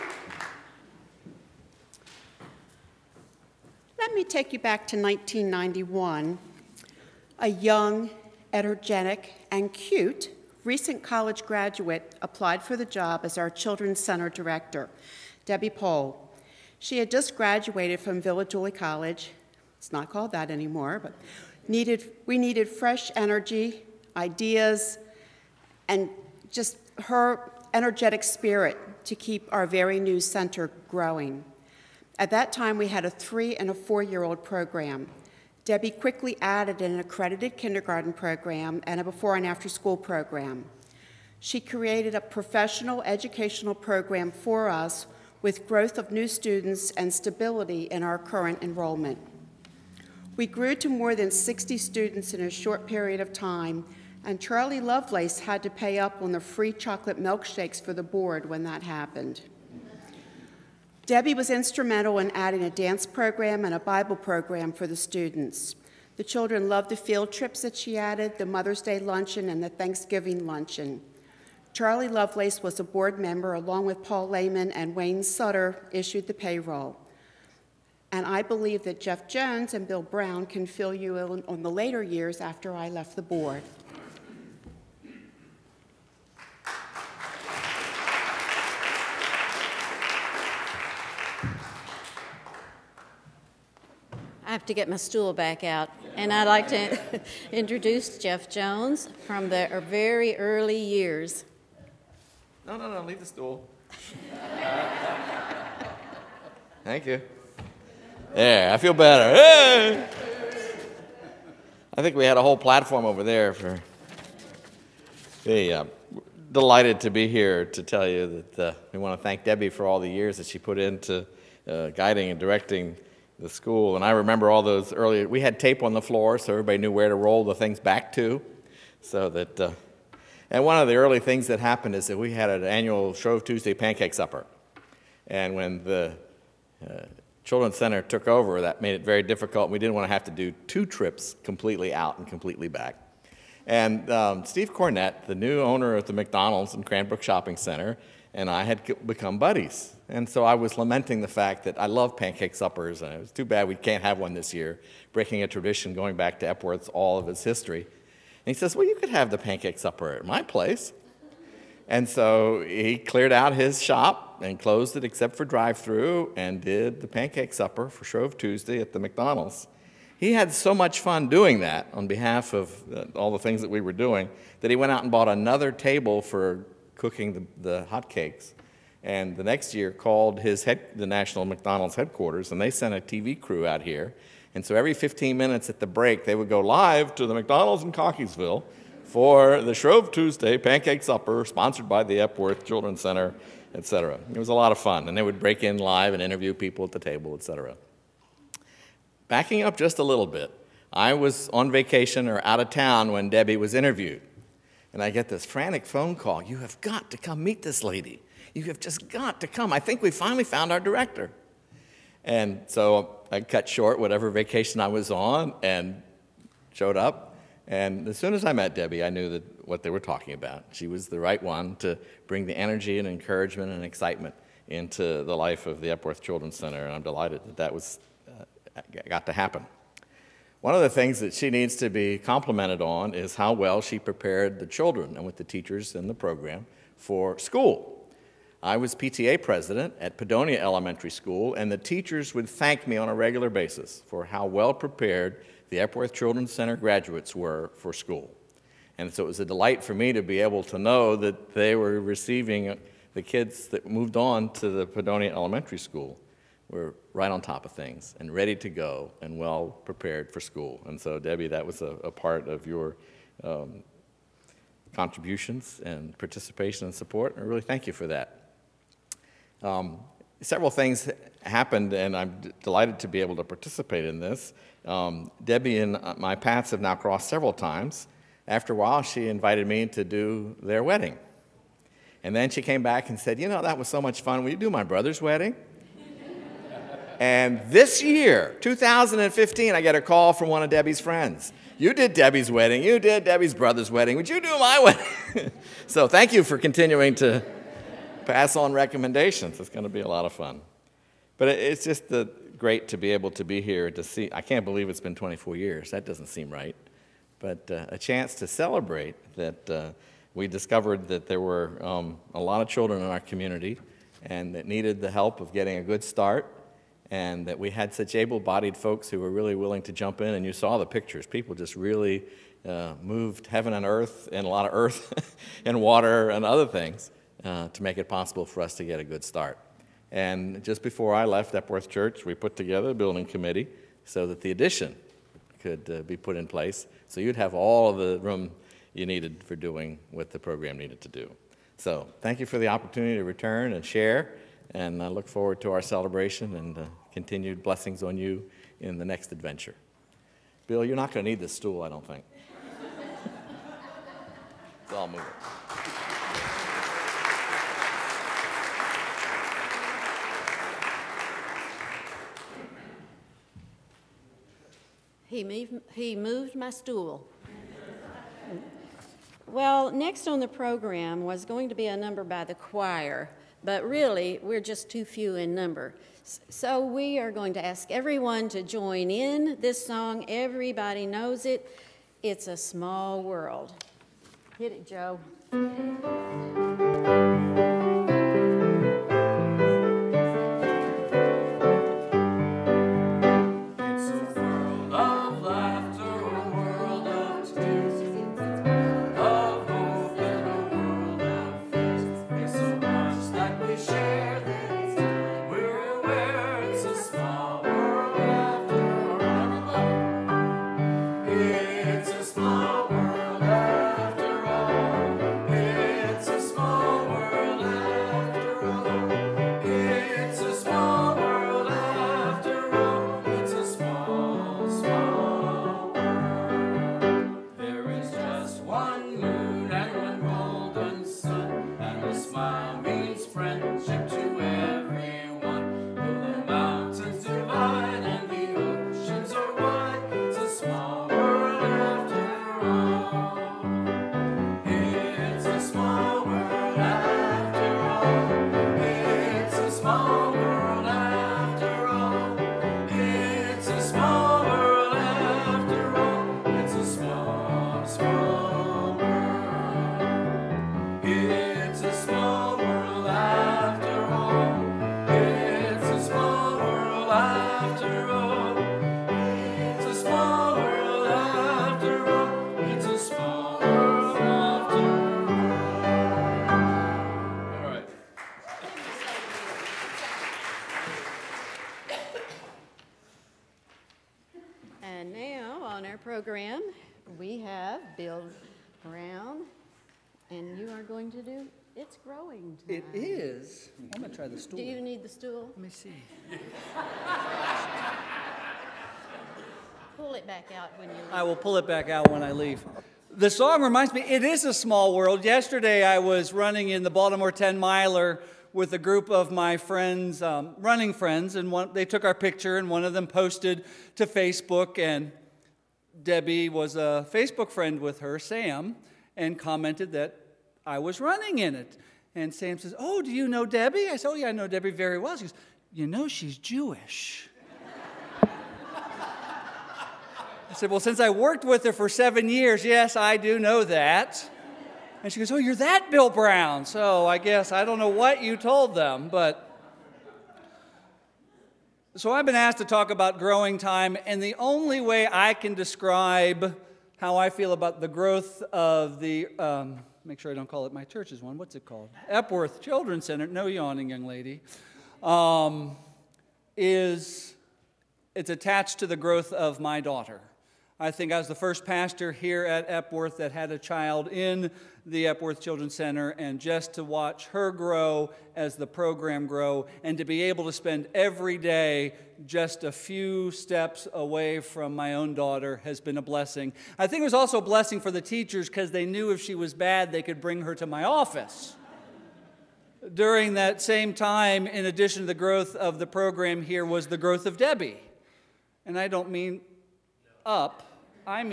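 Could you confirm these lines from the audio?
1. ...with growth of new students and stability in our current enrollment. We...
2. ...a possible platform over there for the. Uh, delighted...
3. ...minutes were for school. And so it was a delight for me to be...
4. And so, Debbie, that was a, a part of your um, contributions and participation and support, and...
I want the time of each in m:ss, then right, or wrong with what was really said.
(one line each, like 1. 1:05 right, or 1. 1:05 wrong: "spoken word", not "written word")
1. 0:45 right
2. 1:52 wrong: "whole", not "possible"
3. 4:06 wrong: "graduates", not "minutes"
4. 4:20 right.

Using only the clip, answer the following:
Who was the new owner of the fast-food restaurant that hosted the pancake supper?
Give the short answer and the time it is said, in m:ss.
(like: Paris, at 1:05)
Steve Cornett, at 2:24.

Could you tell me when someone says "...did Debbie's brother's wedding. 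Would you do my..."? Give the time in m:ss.
4:52.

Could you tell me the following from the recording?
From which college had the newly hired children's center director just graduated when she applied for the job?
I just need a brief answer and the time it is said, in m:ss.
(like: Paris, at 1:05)
Villa Julie College, at 0:18.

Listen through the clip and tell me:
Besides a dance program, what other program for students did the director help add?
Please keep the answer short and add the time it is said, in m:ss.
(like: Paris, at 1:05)
Bible program, at 1:03.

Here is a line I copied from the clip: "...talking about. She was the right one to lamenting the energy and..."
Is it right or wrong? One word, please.
wrong.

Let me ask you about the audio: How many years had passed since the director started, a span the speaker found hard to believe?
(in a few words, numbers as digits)
24.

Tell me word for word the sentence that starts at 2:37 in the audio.
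And he says, Well, you could have the pancake supper at my place.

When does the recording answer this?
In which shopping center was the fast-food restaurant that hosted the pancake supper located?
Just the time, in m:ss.
2:26.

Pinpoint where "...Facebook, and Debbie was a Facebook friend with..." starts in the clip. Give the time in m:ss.
8:34.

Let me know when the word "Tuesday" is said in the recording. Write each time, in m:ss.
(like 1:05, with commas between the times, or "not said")
2:13, 2:48, 3:10.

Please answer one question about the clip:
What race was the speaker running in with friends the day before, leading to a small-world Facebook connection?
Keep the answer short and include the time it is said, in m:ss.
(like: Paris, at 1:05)
Baltimore 10 miler, at 8:26.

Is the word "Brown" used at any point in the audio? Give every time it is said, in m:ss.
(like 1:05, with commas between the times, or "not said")
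1:20, 8:56.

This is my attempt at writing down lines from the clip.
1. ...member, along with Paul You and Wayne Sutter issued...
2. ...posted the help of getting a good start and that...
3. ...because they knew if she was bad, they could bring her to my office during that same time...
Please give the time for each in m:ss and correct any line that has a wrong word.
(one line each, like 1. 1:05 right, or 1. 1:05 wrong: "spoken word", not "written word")
1. 1:13 wrong: "Lehman", not "You"
2. 5:14 wrong: "needed", not "posted"
3. 9:38 right.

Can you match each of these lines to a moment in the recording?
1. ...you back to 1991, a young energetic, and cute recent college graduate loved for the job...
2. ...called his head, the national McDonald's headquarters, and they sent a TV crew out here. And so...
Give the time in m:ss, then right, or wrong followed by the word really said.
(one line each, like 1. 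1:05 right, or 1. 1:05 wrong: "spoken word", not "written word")
1. 0:04 wrong: "applied", not "loved"
2. 2:59 right.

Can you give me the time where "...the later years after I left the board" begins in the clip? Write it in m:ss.
1:21.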